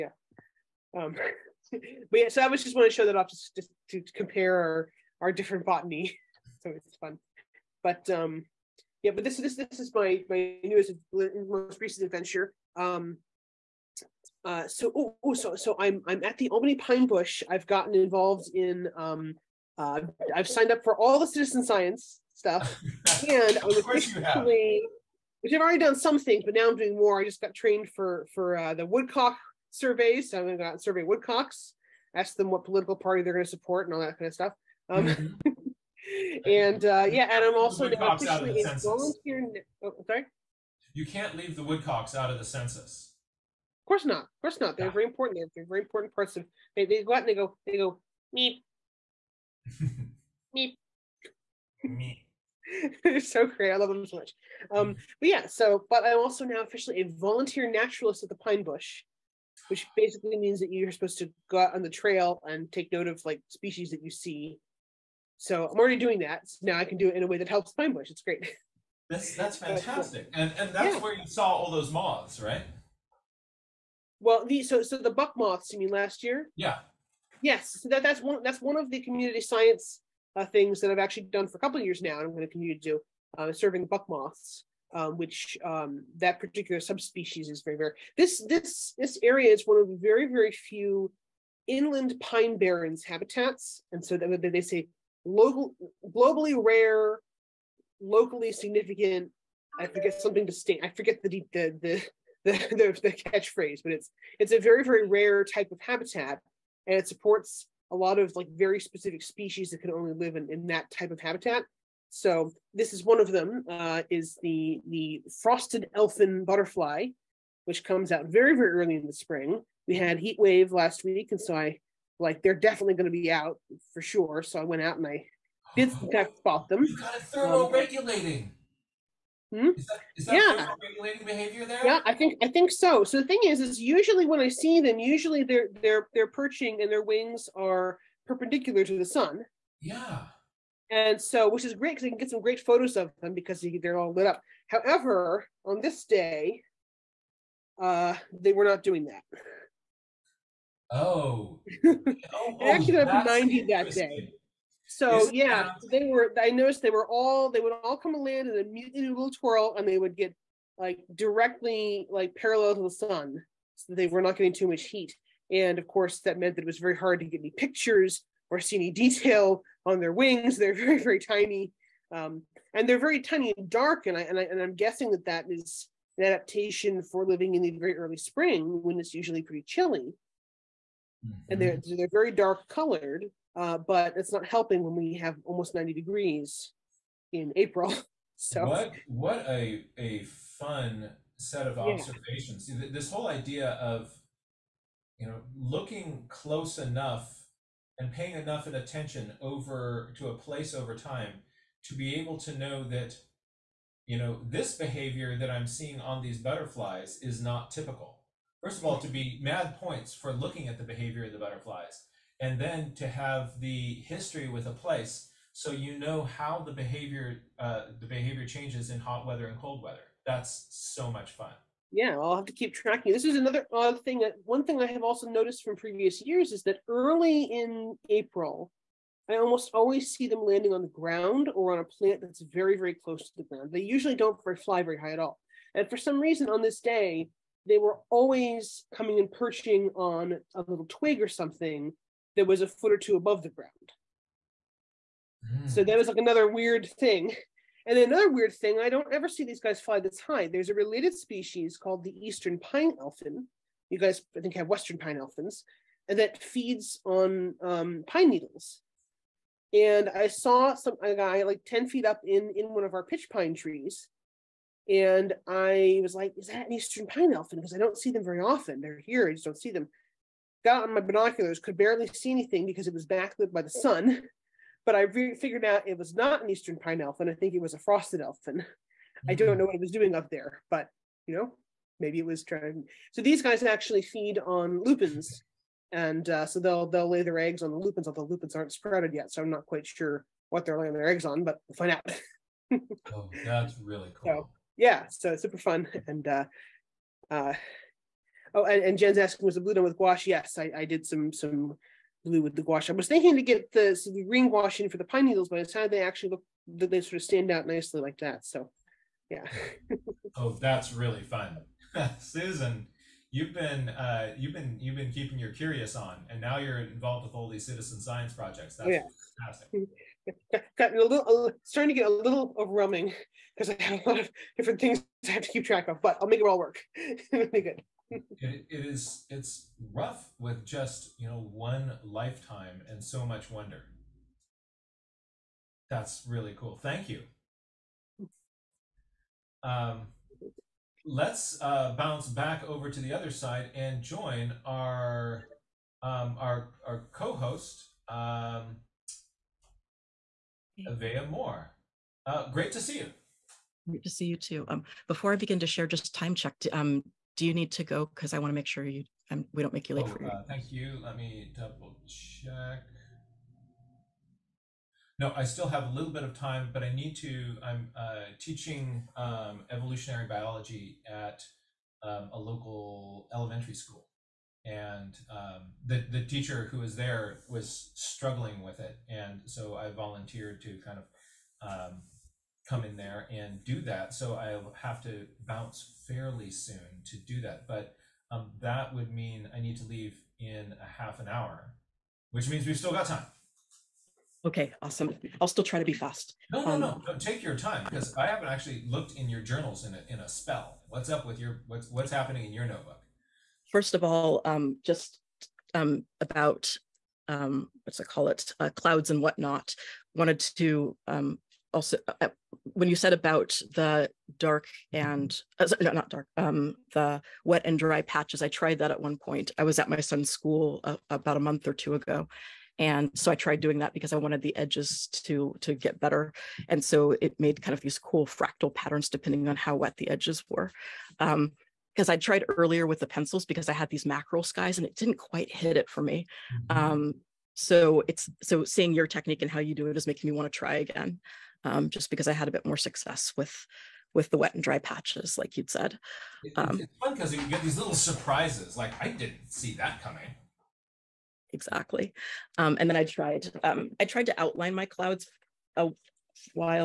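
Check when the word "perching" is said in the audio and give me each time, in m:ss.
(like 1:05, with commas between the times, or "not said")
2:16, 3:59.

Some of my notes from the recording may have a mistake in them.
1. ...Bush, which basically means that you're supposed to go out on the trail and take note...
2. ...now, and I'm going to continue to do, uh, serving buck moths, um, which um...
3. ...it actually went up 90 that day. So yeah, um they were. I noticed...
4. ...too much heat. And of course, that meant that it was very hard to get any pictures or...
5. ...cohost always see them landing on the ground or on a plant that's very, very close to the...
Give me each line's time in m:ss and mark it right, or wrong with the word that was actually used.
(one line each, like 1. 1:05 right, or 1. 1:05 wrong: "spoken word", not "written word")
1. 0:58 right
2. 1:22 right
3. 2:32 right
4. 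2:44 right
5. 3:49 wrong: "almost", not "cohost".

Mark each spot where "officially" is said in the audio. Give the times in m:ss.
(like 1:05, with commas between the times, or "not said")
0:23, 0:38, 0:56.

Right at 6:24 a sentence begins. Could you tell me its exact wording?
So I'll have to bounce fairly soon to do that.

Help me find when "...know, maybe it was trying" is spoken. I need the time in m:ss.
4:41.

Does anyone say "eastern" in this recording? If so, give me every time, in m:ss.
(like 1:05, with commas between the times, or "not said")
4:12, 4:26, 4:36.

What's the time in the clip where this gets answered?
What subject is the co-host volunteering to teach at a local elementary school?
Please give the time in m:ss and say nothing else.
6:09.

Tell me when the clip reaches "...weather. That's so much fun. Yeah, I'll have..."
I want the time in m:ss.
3:39.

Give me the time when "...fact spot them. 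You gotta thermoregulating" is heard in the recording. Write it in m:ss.
2:06.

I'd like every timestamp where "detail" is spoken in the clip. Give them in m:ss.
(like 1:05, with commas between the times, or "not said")
2:48.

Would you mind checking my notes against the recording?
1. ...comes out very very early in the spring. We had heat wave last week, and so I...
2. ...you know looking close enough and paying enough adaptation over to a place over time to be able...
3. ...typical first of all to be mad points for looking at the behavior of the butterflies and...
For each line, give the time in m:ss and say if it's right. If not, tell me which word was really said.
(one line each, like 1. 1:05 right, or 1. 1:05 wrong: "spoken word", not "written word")
1. 1:57 right
2. 3:15 wrong: "attention", not "adaptation"
3. 3:27 right.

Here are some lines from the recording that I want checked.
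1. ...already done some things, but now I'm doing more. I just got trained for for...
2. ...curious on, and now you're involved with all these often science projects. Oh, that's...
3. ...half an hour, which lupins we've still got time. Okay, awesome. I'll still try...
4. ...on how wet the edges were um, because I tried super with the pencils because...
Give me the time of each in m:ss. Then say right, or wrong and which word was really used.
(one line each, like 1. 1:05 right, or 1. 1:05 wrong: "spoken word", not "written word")
1. 0:25 right
2. 5:15 wrong: "citizen", not "often"
3. 6:31 wrong: "means", not "lupins"
4. 7:09 wrong: "earlier", not "super".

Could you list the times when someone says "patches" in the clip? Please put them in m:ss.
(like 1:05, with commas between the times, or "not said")
6:58, 7:24.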